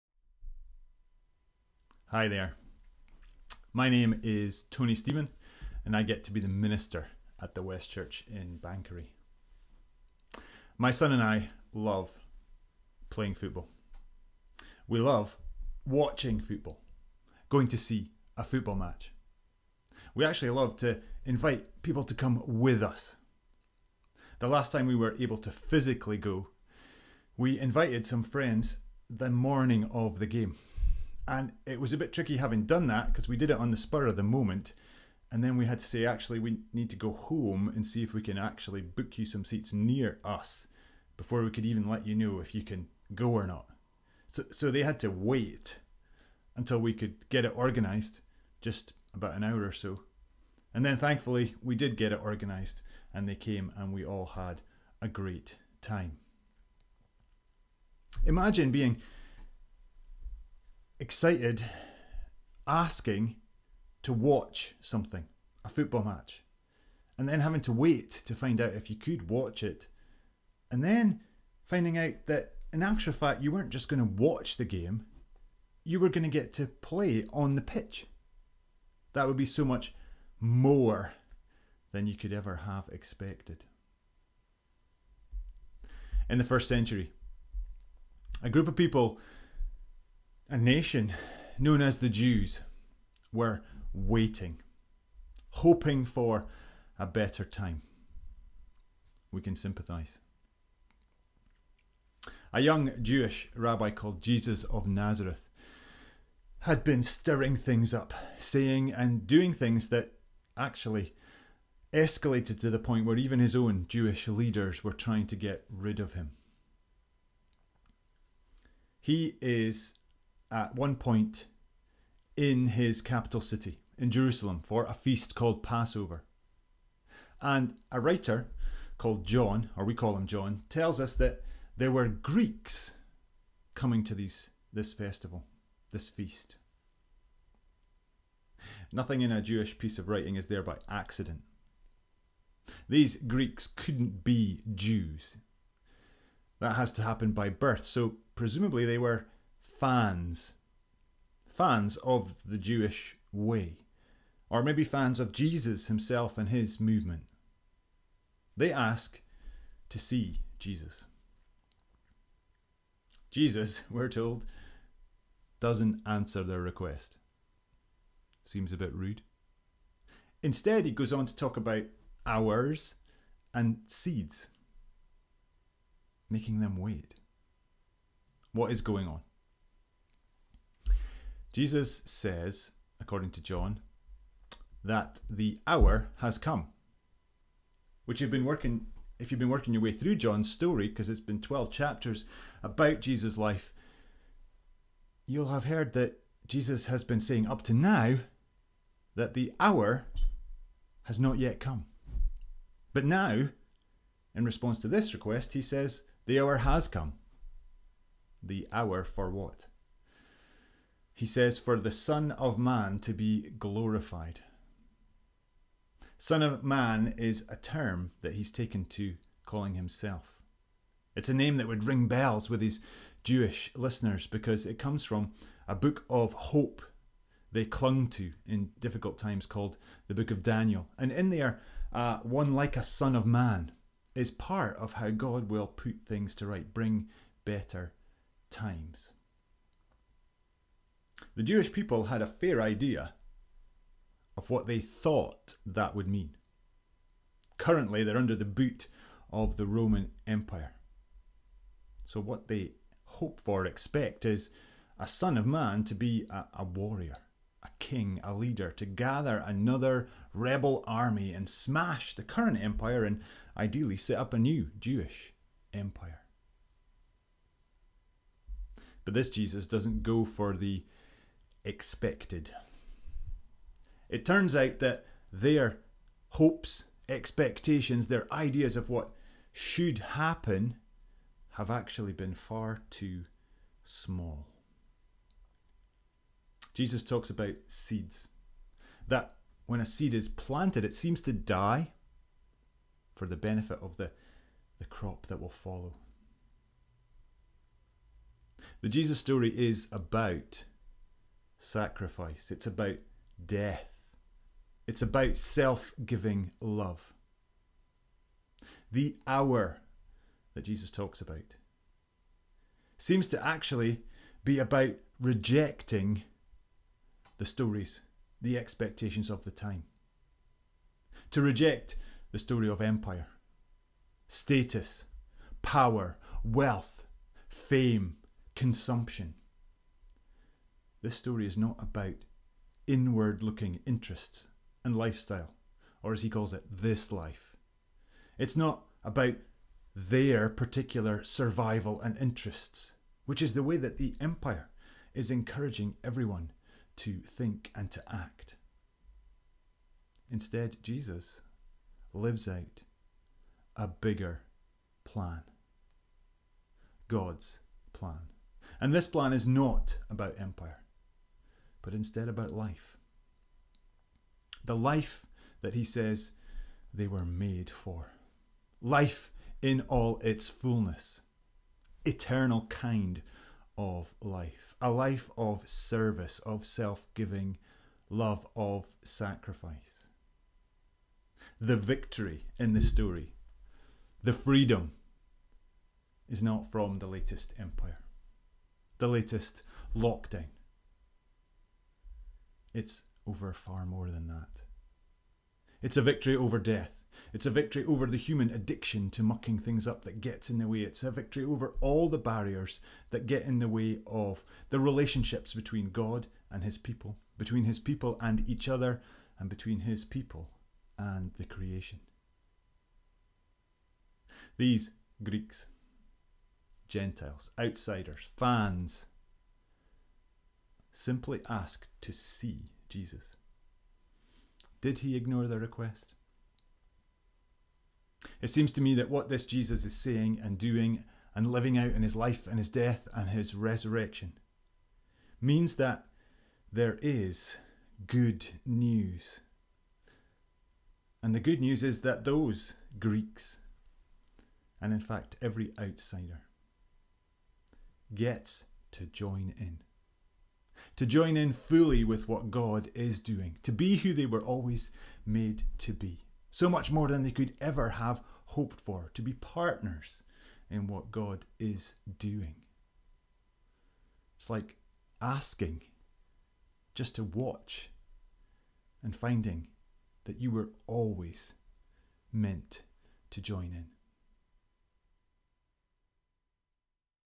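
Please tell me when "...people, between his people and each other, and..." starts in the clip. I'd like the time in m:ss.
6:46.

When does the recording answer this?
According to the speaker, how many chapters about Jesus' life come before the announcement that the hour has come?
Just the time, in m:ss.
3:11.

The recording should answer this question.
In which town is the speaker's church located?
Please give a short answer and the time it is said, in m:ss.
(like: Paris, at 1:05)
Banchory, at 0:08.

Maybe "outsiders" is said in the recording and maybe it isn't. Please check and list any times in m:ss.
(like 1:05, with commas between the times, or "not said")
6:57, 7:25.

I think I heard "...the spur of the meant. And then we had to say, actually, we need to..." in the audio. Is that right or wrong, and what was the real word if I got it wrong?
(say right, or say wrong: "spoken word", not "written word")
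wrong: "moment", not "meant".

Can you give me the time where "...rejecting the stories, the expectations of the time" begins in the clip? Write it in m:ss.
5:15.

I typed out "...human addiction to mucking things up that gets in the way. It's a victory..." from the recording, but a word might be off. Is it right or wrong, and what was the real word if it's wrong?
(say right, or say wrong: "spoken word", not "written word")
right.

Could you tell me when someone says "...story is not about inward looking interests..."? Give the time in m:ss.
5:31.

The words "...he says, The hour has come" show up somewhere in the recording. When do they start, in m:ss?
3:25.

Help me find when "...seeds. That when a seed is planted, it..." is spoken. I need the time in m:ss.
4:47.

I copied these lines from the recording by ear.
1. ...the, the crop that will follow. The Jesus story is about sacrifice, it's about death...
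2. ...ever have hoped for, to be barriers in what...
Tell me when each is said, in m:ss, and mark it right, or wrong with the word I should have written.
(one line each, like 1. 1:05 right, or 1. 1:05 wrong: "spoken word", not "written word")
1. 4:53 right
2. 7:37 wrong: "partners", not "barriers".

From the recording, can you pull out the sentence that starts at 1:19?
That would be so much more than you could ever have expected.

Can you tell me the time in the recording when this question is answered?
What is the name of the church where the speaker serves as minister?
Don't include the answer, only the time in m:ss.
0:07.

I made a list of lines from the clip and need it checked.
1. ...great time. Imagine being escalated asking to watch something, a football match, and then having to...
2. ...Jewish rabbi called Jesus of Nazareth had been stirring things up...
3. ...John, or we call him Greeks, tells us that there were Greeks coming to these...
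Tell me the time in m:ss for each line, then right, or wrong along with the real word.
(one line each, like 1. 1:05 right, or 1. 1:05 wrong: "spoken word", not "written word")
1. 0:55 wrong: "excited", not "escalated"
2. 1:43 right
3. 2:09 wrong: "John", not "Greeks".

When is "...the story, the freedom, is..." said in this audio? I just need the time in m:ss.
6:22.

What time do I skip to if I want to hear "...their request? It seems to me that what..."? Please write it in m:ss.
7:05.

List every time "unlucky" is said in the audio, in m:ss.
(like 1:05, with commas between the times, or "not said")
not said.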